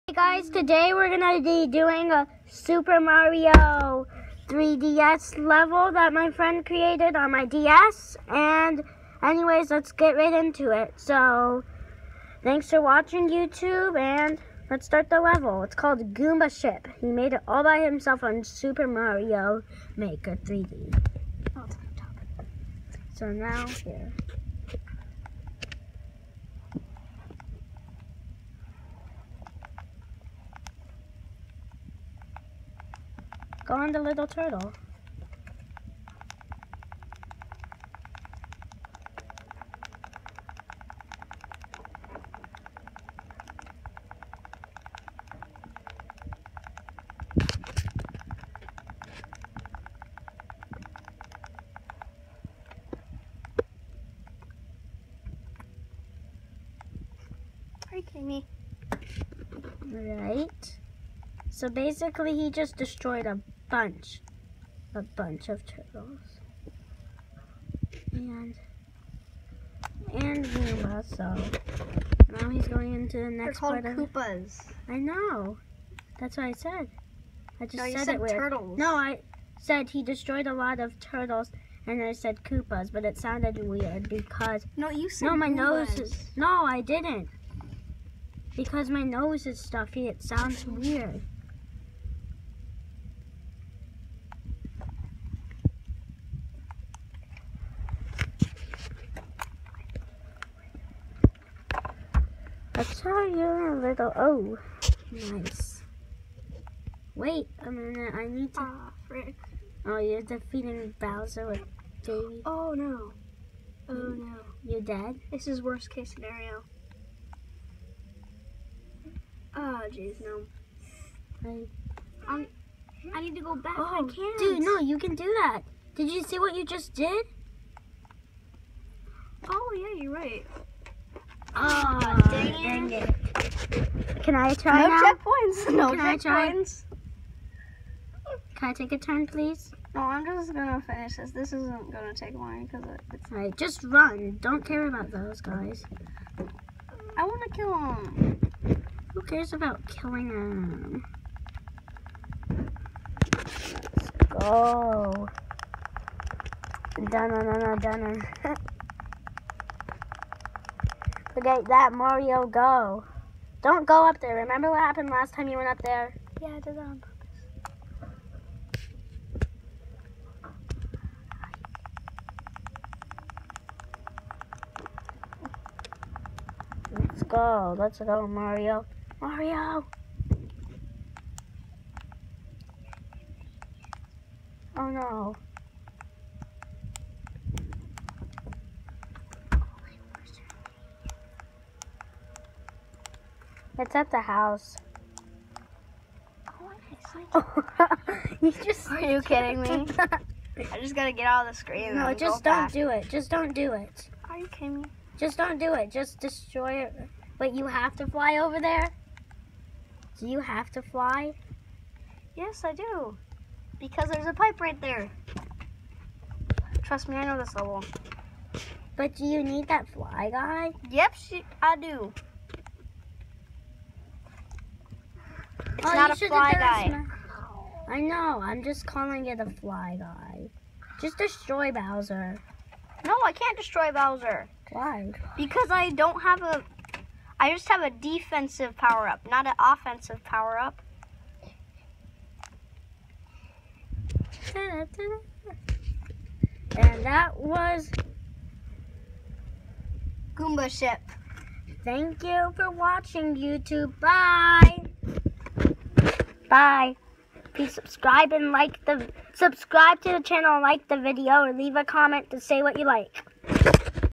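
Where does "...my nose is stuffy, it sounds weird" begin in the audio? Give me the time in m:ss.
1:28.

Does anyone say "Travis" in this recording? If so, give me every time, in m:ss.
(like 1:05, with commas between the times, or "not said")
not said.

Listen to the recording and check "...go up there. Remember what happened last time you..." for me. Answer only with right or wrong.
right.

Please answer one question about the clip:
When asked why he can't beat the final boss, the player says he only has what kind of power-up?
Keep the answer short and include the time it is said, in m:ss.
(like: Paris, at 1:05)
defensive, at 3:57.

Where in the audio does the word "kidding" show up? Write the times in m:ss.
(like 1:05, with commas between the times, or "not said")
3:19, 3:24.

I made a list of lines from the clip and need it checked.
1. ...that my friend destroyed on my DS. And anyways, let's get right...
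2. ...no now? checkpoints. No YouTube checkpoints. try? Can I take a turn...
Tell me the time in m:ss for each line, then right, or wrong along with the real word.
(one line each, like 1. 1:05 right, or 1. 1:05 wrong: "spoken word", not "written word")
1. 0:05 wrong: "created", not "destroyed"
2. 2:14 wrong: "Can", not "YouTube".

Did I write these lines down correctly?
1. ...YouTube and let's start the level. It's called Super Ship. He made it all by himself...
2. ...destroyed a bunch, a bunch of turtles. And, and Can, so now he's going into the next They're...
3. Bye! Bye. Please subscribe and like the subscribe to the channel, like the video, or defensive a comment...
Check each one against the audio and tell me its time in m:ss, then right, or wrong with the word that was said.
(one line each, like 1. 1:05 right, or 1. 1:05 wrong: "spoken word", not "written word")
1. 0:13 wrong: "Goomba", not "Super"
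2. 1:02 wrong: "Goomba", not "Can"
3. 4:13 wrong: "leave", not "defensive".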